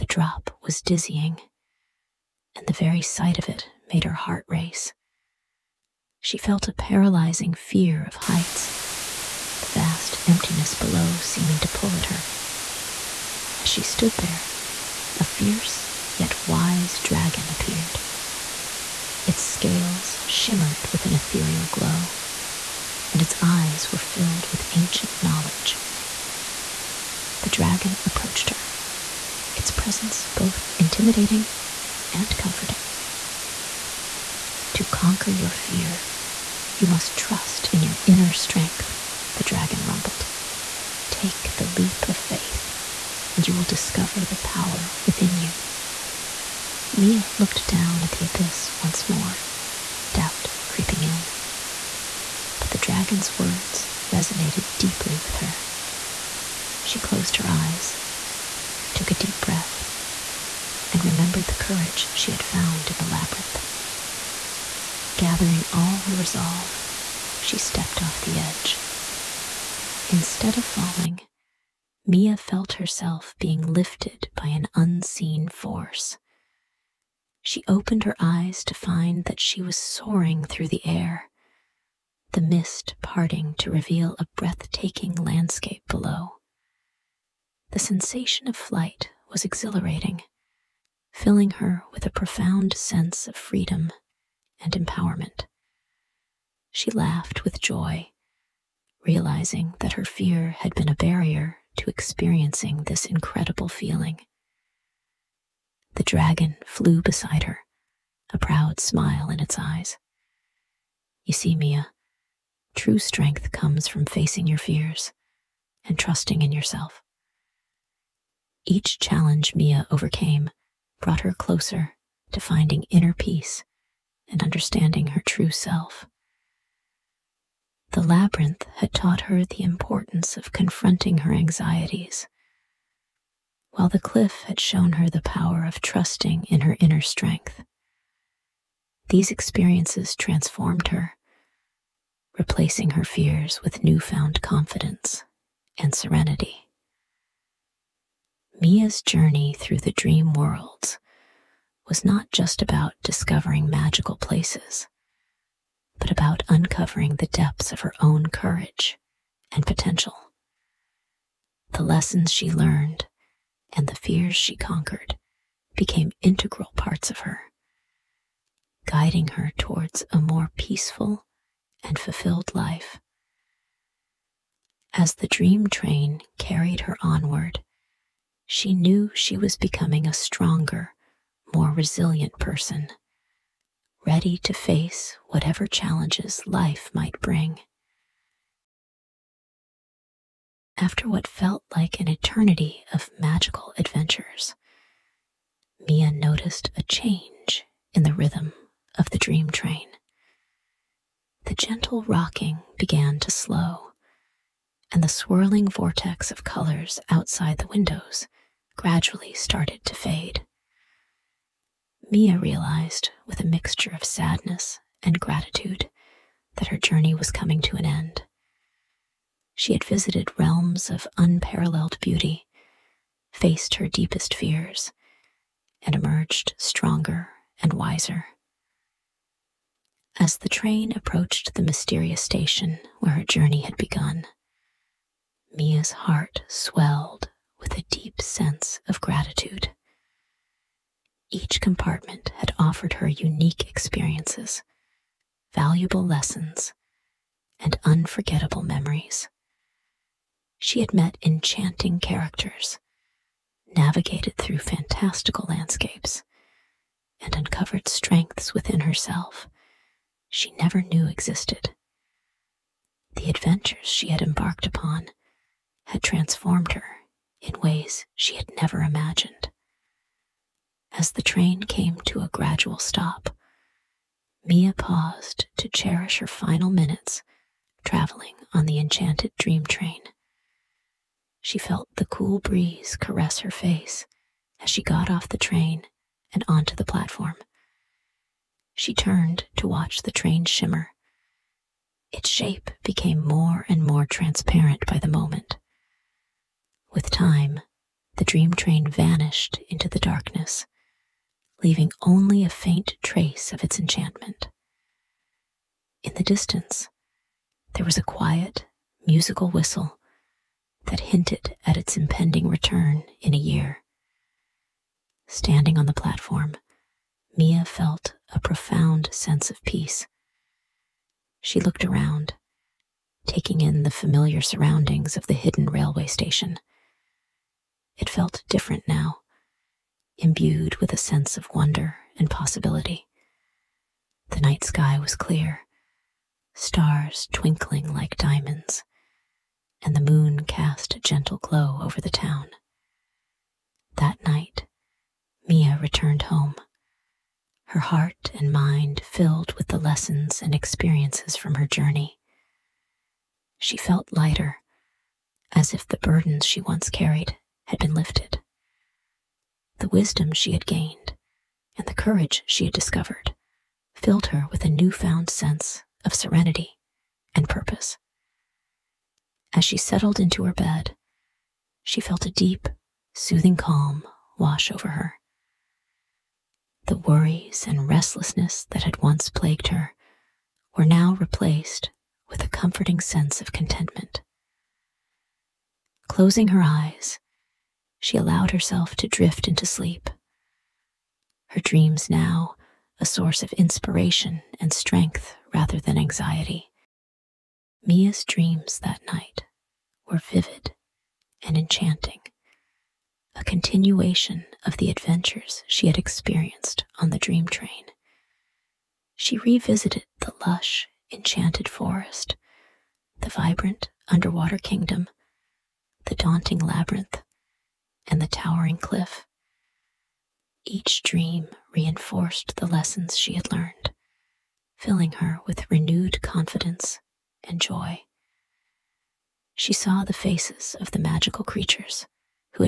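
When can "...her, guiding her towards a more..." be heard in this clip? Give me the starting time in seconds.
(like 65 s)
167 s.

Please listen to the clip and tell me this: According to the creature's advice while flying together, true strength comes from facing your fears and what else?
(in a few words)
trusting in yourself.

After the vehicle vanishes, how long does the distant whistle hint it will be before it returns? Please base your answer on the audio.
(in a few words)
a year.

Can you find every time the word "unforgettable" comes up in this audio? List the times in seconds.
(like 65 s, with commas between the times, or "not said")
247 s.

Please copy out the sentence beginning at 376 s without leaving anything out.
The worries and restlessness that had once plagued her were now replaced with a comforting sense of contentment.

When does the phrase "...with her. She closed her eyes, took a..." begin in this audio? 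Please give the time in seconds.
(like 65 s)
55 s.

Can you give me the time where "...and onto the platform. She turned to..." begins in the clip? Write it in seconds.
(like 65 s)
286 s.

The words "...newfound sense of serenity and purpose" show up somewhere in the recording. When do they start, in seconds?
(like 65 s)
364 s.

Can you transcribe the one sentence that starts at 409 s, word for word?
She revisited the lush, enchanted forest, the vibrant underwater kingdom, the daunting labyrinth, and the towering cliff.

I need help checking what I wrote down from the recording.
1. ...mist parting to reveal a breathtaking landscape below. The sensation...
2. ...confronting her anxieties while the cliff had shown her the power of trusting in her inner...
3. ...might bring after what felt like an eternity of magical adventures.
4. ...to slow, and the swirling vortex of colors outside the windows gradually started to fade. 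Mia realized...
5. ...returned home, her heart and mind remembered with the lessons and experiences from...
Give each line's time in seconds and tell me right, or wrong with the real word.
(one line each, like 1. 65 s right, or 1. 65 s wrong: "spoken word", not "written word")
1. 82 s right
2. 130 s right
3. 186 s right
4. 203 s right
5. 345 s wrong: "filled", not "remembered".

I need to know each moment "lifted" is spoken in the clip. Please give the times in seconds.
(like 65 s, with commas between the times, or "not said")
73 s, 357 s.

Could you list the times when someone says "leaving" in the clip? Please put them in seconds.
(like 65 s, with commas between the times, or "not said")
301 s.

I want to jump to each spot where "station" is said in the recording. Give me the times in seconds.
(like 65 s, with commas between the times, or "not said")
232 s, 326 s.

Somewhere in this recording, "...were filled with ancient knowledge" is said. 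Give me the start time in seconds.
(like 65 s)
23 s.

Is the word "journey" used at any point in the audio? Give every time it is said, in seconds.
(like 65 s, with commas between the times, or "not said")
149 s, 216 s, 233 s, 351 s.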